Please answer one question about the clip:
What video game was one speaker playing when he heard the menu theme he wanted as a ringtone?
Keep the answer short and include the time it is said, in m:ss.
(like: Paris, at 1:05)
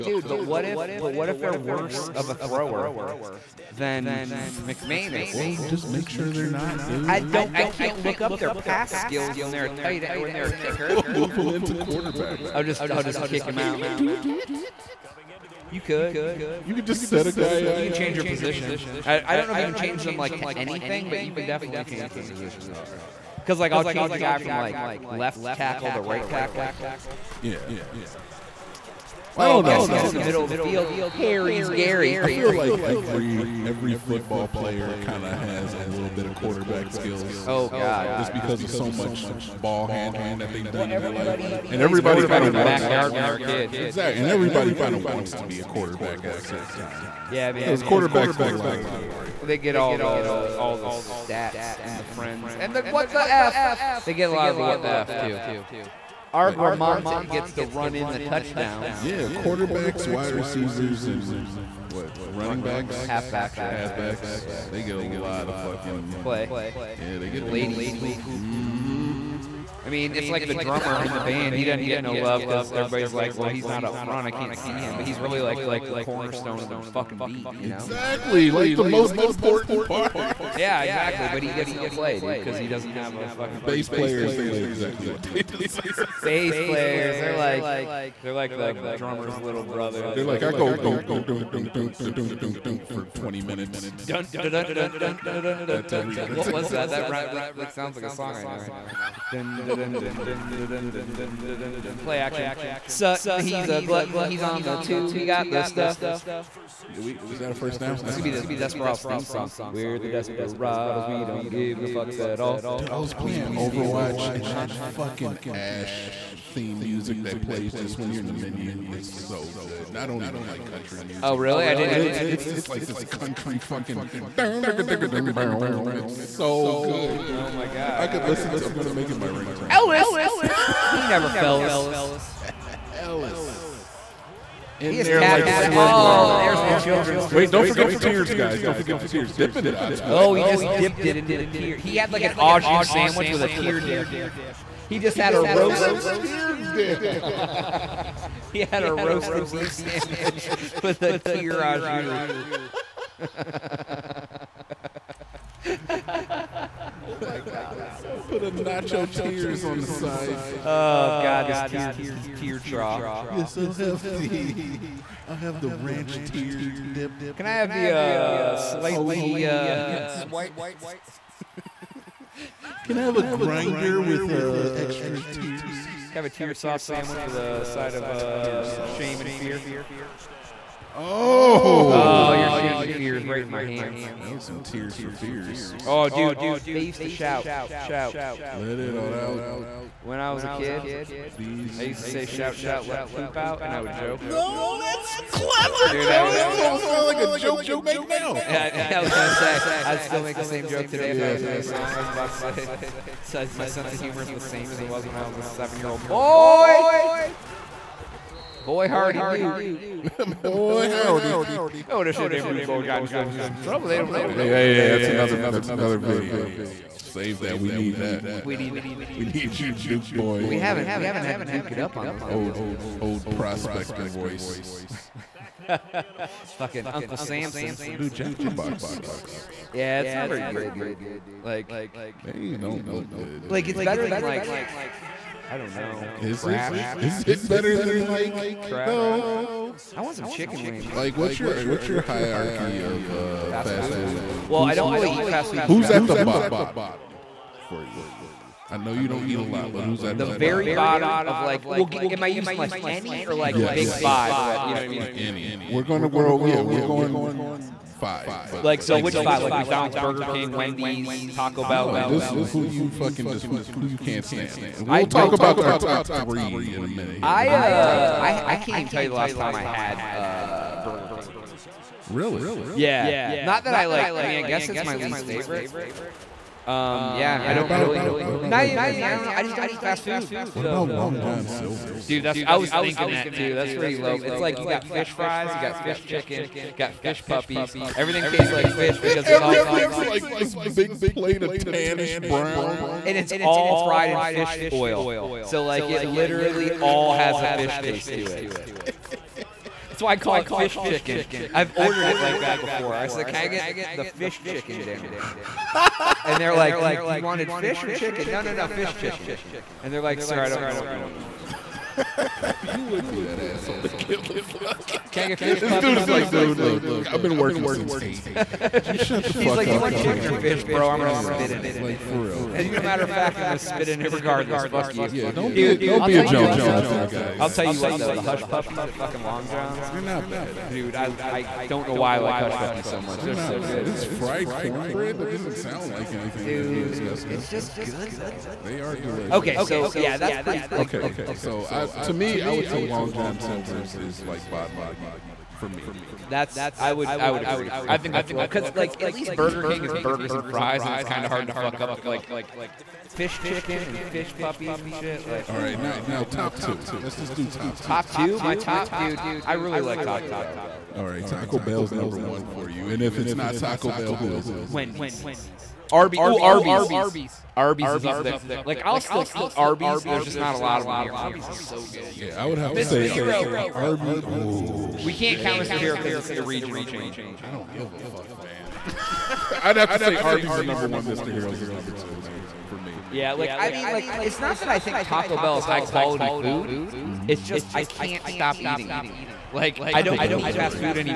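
Overwatch, at 1:53.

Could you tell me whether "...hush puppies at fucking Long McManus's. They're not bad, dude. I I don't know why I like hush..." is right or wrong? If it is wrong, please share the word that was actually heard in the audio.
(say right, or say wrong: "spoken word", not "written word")
wrong: "John", not "McManus".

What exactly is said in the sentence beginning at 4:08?
I know you don't eat a lot, but who's at the, the very bottom?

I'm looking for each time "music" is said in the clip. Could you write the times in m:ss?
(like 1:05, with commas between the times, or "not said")
1:56, 2:01.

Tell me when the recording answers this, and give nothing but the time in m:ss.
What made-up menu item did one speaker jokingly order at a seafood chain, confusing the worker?
5:04.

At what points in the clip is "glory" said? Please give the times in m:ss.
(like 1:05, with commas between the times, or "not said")
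0:49.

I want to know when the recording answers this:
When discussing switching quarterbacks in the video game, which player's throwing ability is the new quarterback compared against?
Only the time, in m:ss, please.
0:04.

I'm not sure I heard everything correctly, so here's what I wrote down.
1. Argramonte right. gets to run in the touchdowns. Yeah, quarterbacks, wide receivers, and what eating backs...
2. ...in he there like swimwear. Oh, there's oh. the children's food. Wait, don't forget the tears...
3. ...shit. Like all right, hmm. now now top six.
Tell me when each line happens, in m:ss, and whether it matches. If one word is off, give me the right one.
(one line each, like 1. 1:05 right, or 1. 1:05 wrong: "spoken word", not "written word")
1. 0:56 wrong: "running", not "eating"
2. 2:14 right
3. 5:54 wrong: "two", not "six".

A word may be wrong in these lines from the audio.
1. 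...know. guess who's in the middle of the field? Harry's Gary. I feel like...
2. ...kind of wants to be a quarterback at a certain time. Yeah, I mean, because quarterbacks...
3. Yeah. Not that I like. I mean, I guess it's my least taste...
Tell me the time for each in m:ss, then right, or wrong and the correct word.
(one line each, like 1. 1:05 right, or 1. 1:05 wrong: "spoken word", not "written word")
1. 0:29 right
2. 0:44 right
3. 4:32 wrong: "favorite", not "taste".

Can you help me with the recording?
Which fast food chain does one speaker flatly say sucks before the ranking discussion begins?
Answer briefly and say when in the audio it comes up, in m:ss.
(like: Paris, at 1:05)
Jack in the Box, at 3:48.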